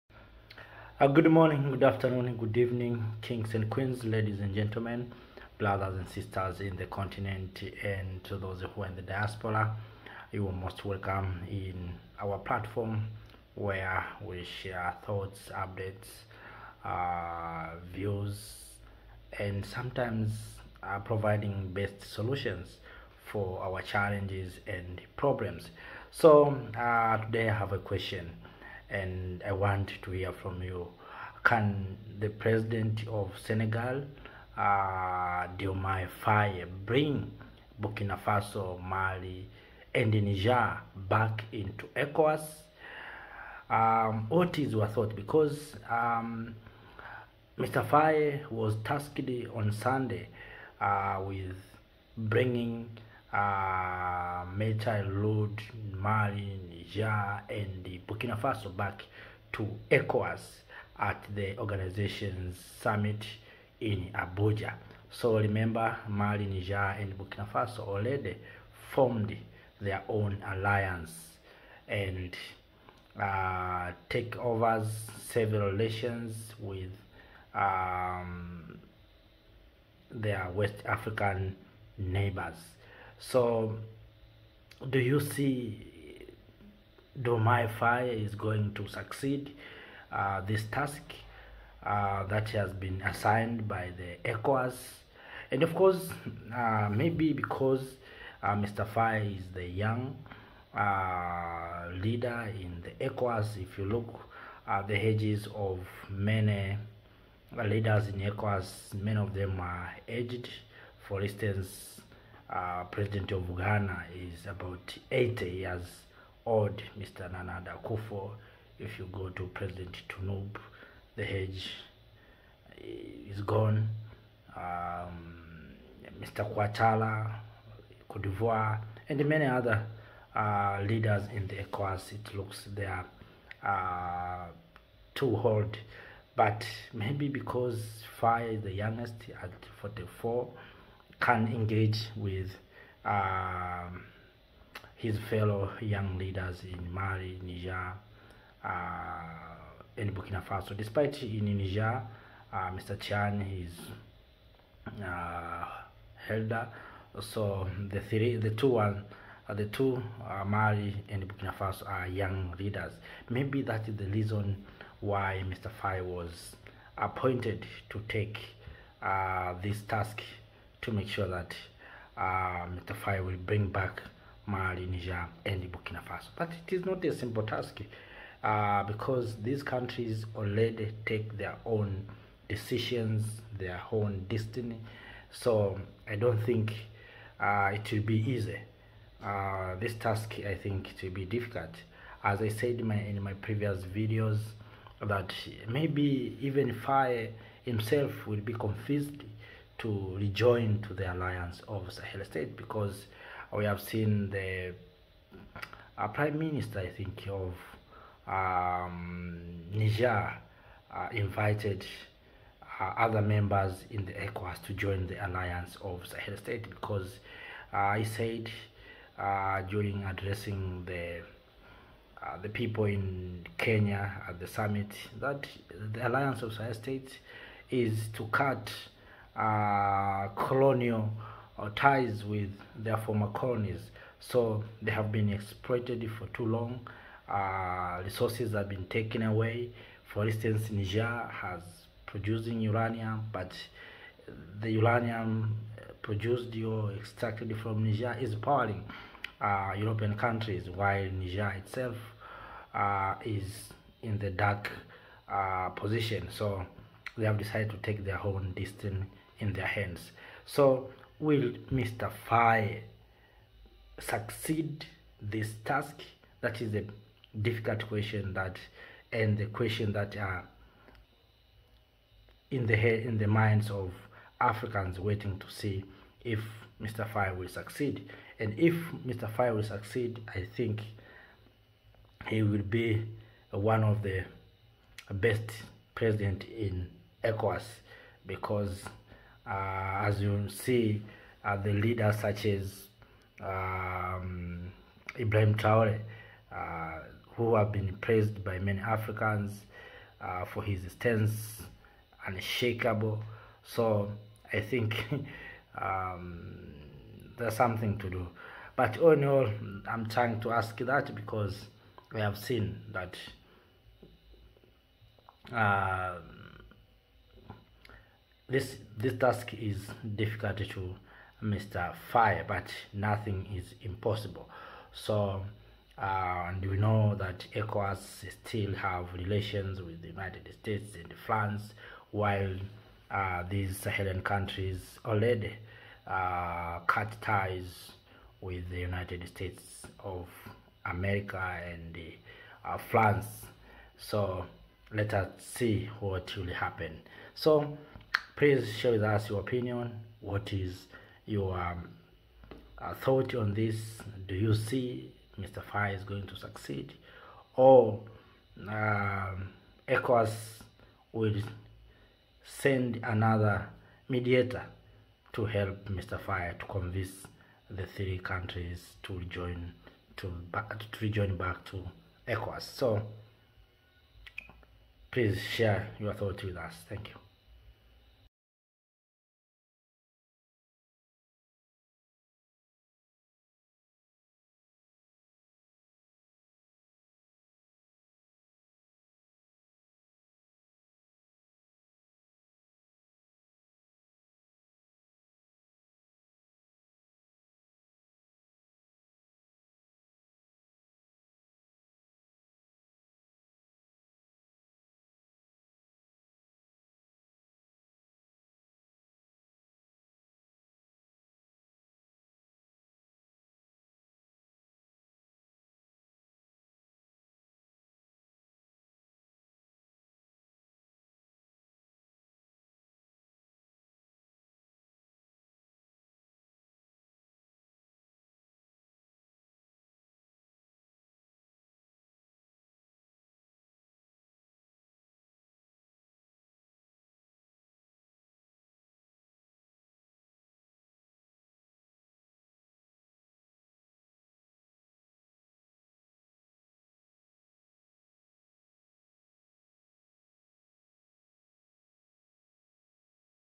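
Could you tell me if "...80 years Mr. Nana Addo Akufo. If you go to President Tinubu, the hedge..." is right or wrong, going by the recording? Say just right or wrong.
right.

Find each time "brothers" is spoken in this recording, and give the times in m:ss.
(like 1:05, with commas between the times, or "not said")
0:05.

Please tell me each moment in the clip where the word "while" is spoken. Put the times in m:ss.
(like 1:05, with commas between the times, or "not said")
4:10, 5:32.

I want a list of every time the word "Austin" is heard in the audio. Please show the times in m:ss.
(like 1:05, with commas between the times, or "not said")
not said.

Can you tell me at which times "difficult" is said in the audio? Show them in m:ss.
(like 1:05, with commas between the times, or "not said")
3:11, 4:27, 5:20.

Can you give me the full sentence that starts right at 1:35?
And of course, uh, maybe because uh, Mr.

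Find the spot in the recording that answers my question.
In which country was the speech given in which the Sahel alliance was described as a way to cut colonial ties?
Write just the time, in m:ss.
3:43.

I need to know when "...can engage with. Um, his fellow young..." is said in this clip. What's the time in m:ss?
2:21.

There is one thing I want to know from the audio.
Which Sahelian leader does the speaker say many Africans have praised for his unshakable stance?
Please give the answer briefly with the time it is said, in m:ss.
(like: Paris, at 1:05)
Ibrahim Traore, at 4:55.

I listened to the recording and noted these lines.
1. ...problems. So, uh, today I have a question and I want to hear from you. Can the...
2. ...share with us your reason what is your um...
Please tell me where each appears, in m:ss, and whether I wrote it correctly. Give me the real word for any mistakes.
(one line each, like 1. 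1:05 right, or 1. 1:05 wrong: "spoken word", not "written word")
1. 0:25 right
2. 5:48 wrong: "opinion", not "reason".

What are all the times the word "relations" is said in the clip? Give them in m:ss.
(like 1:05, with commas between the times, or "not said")
1:15, 5:29.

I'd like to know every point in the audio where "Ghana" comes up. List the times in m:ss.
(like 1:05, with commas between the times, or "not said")
1:53.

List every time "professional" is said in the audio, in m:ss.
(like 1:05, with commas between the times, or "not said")
not said.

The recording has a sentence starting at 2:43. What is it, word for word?
Maybe that is the reason why Mr.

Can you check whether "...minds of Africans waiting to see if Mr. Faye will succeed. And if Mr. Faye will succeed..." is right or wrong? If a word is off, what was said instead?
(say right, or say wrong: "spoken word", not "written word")
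right.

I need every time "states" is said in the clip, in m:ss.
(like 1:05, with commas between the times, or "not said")
3:22, 3:36, 3:46, 5:30, 5:39.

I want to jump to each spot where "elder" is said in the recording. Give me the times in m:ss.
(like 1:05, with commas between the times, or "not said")
2:36.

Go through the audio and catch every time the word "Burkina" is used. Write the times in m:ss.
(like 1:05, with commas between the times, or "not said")
0:37, 0:58, 1:07, 2:30, 2:41, 2:55.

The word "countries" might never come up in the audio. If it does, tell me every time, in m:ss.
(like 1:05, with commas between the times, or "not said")
2:59, 4:10, 5:34, 6:08.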